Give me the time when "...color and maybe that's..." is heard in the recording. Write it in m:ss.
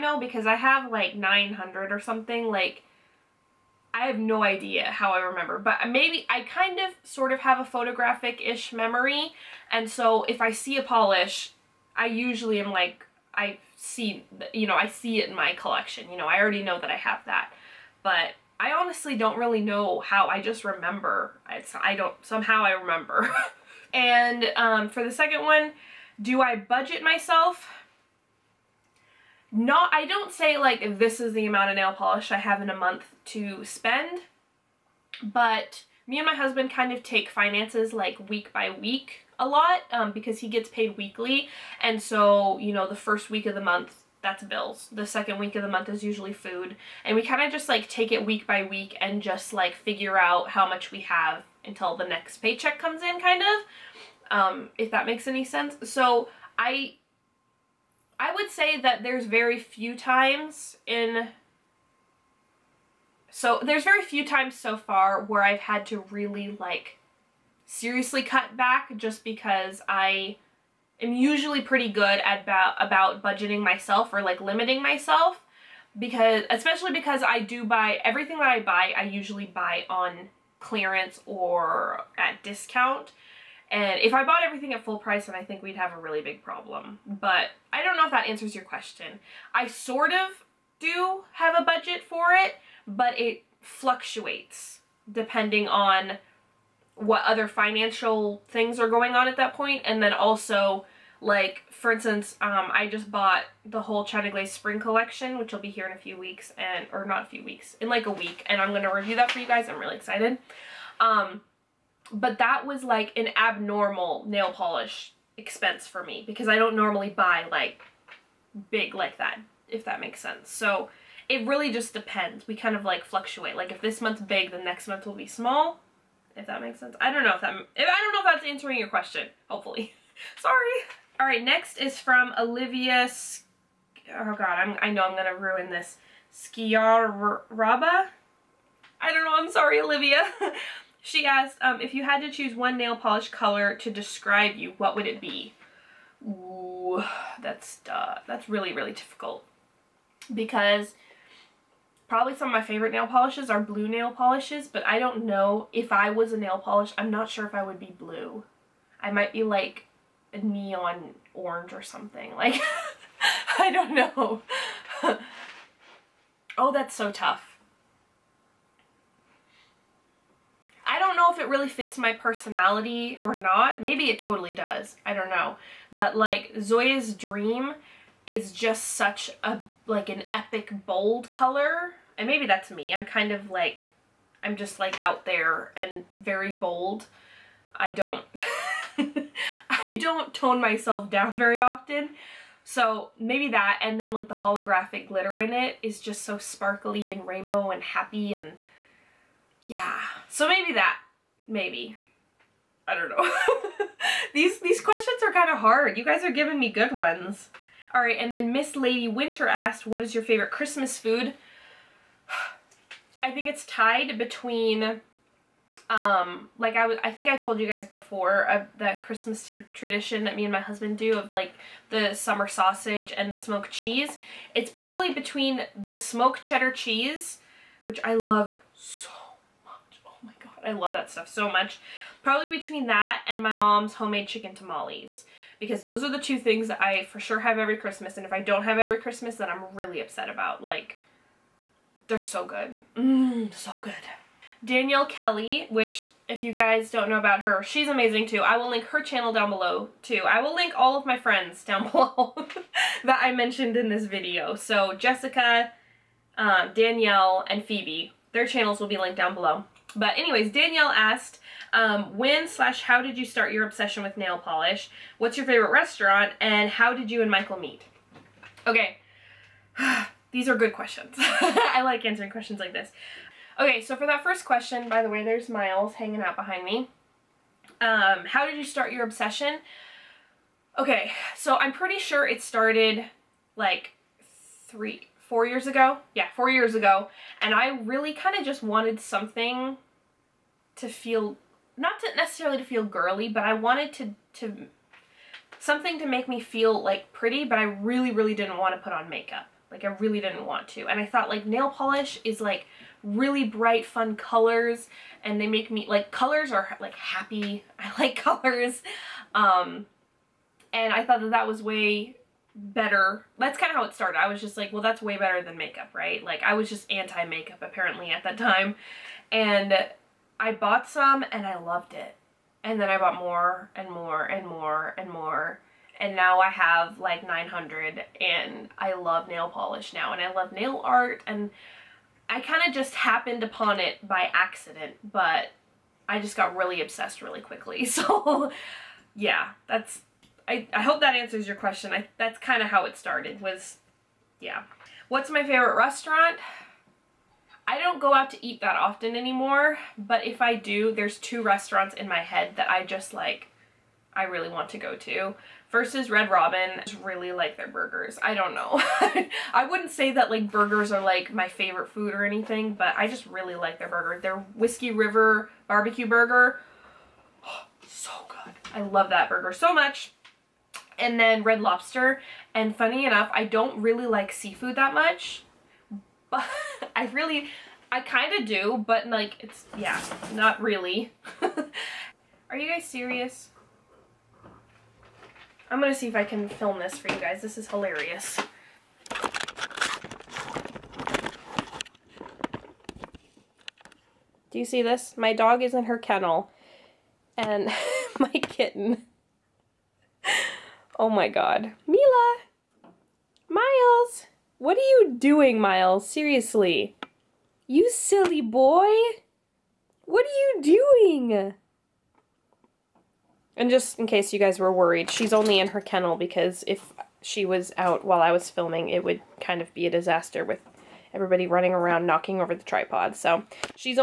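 3:01.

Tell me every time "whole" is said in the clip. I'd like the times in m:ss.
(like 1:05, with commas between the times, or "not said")
1:43.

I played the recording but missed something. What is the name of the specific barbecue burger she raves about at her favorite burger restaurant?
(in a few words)
Whiskey River barbecue burger.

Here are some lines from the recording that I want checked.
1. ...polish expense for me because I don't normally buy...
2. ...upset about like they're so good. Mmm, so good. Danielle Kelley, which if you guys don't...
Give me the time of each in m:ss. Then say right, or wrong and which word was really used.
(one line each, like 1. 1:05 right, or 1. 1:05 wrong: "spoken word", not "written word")
1. 1:54 right
2. 4:00 right.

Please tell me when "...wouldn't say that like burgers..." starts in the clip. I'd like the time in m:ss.
5:59.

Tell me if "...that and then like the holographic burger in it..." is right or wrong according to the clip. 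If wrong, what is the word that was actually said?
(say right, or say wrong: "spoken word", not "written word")
wrong: "glitter", not "burger".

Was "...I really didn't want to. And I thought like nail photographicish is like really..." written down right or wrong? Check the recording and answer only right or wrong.
wrong.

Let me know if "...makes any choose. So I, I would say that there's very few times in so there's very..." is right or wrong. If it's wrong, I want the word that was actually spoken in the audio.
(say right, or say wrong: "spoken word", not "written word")
wrong: "sense", not "choose".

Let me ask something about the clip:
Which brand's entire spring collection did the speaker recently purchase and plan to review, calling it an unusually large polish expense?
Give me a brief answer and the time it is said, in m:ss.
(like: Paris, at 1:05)
China Glaze, at 1:44.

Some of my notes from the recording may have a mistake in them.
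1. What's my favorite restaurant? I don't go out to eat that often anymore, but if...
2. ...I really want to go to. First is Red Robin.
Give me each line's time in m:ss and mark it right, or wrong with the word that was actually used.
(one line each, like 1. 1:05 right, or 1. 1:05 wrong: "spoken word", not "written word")
1. 5:45 right
2. 5:54 right.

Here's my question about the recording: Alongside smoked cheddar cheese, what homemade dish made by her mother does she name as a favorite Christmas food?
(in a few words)
chicken tamales.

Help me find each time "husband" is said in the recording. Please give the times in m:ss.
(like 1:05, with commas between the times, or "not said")
0:36, 3:40.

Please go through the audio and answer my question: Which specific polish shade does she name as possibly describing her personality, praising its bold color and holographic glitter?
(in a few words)
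Zoya's Dream.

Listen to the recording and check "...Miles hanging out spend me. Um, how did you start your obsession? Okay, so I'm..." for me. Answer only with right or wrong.
wrong.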